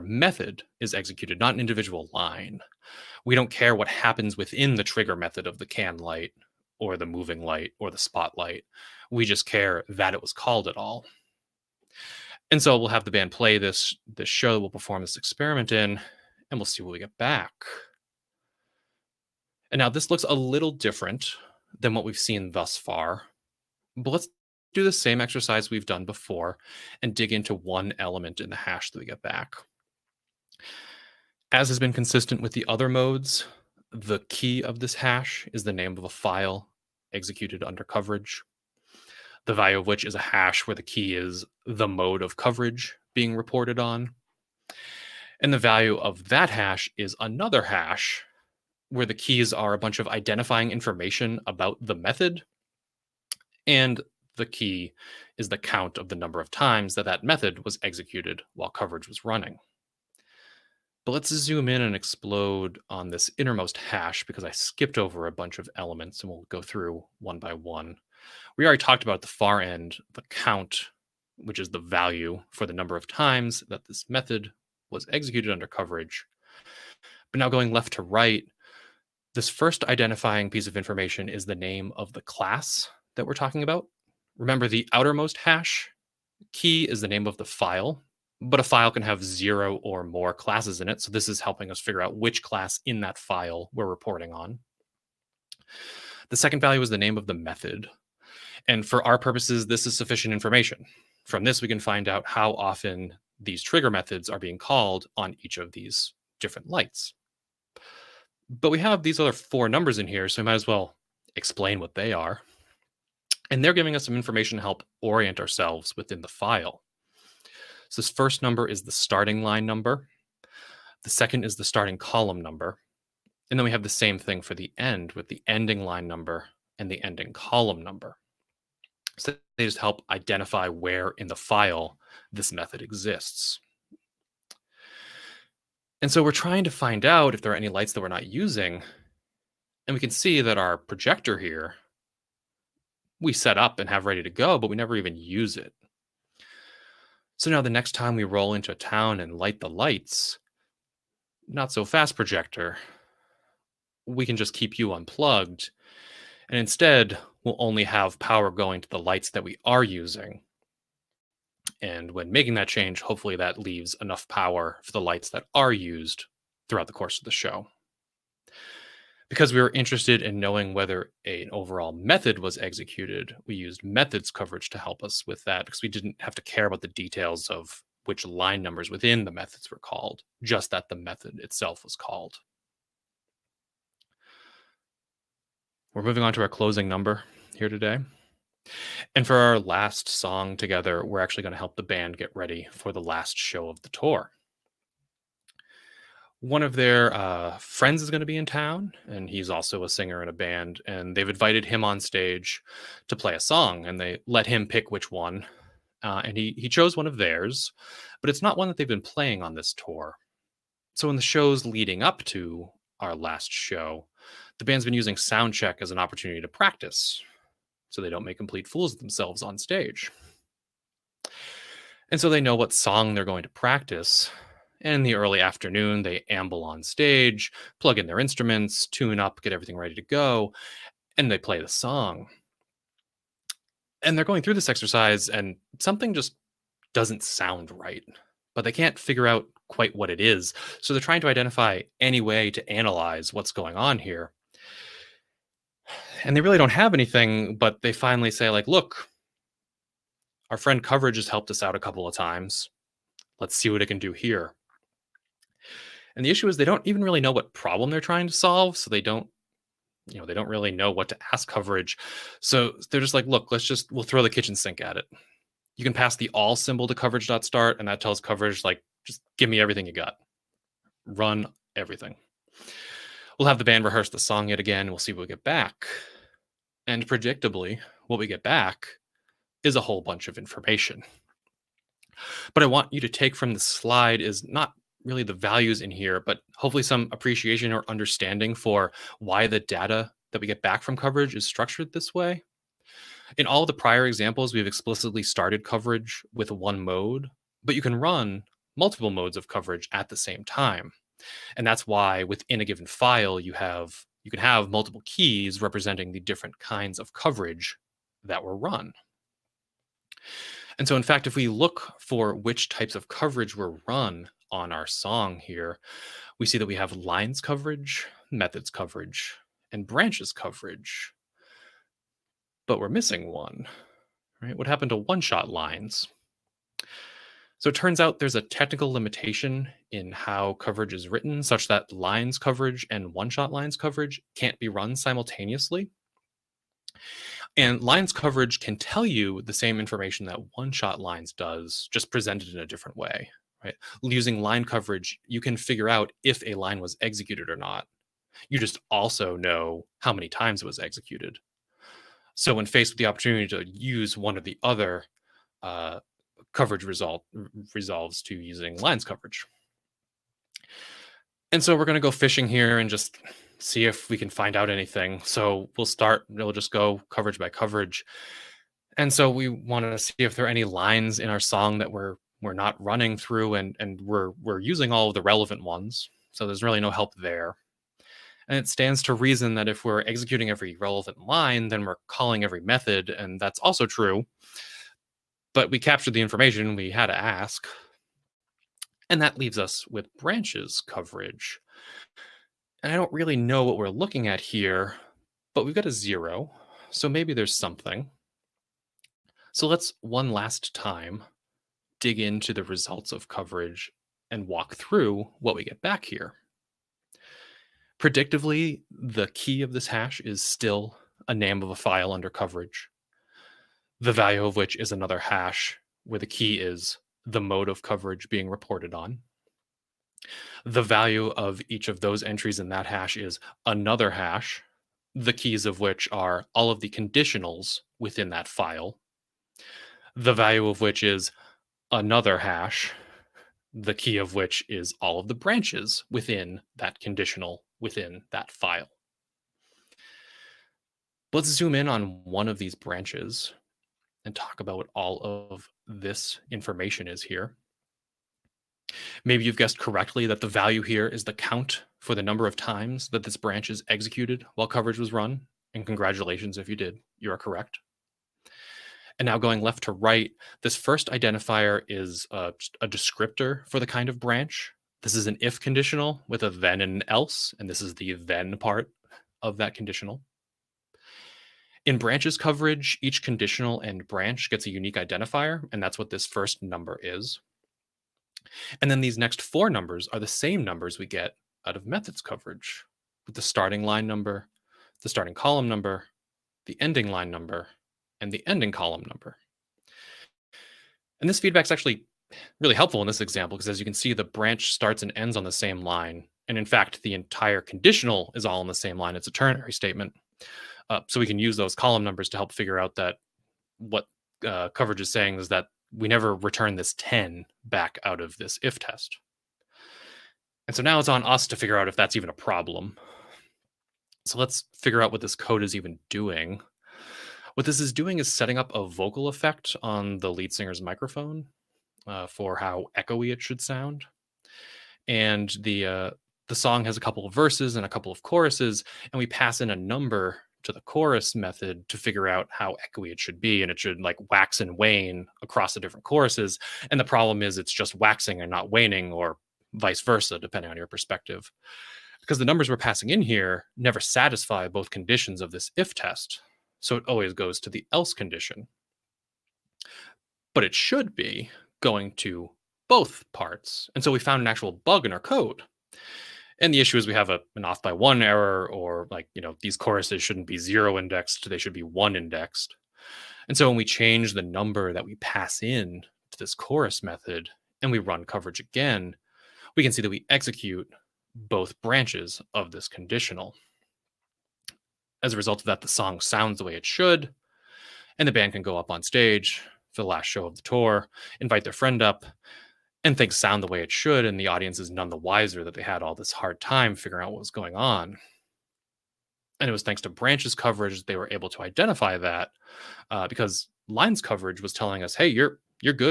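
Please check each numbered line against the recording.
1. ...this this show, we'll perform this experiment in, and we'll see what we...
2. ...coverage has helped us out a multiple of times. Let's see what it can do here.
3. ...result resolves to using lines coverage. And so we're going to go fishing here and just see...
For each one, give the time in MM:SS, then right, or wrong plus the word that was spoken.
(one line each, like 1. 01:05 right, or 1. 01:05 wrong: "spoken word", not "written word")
1. 00:13 right
2. 04:10 wrong: "couple", not "multiple"
3. 05:56 right.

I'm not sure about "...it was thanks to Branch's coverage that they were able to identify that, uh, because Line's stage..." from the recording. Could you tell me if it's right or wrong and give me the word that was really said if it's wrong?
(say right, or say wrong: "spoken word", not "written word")
wrong: "coverage", not "stage".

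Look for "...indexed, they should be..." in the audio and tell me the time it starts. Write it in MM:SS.
09:20.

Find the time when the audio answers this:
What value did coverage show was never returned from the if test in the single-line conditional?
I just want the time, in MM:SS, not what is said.
08:26.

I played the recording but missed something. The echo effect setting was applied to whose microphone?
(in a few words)
lead singer.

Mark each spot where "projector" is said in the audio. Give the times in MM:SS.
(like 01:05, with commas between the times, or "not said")
02:20, 02:32.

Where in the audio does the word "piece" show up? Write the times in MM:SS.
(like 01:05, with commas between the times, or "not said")
01:20.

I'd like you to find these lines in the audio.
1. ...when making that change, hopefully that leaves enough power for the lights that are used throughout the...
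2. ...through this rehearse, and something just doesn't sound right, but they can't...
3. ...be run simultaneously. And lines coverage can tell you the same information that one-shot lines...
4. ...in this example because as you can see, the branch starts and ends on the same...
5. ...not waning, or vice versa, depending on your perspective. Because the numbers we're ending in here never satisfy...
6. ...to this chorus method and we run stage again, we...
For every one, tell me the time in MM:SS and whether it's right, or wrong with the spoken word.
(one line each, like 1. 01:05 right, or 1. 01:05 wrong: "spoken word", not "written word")
1. 02:42 right
2. 03:54 wrong: "exercise", not "rehearse"
3. 05:34 right
4. 08:13 right
5. 08:58 wrong: "passing", not "ending"
6. 09:26 wrong: "coverage", not "stage".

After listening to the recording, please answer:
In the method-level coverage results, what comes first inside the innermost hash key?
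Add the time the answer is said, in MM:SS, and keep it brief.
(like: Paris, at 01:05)
name of the class, at 01:21.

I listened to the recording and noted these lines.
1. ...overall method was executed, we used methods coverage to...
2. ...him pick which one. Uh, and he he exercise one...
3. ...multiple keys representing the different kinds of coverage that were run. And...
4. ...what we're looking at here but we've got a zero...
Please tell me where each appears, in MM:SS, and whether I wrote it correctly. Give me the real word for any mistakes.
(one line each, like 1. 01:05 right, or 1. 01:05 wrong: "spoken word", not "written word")
1. 02:51 right
2. 03:24 wrong: "chose", not "exercise"
3. 05:04 right
4. 06:33 right.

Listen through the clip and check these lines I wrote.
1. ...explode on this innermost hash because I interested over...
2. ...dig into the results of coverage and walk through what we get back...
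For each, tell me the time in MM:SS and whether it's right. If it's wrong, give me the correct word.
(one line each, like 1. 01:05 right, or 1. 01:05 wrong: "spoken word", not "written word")
1. 01:01 wrong: "skipped", not "interested"
2. 06:42 right.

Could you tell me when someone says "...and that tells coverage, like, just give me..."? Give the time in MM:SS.
04:27.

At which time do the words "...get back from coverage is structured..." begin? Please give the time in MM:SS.
04:50.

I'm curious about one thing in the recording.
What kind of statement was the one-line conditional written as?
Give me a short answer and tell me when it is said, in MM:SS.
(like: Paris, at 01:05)
ternary statement, at 08:19.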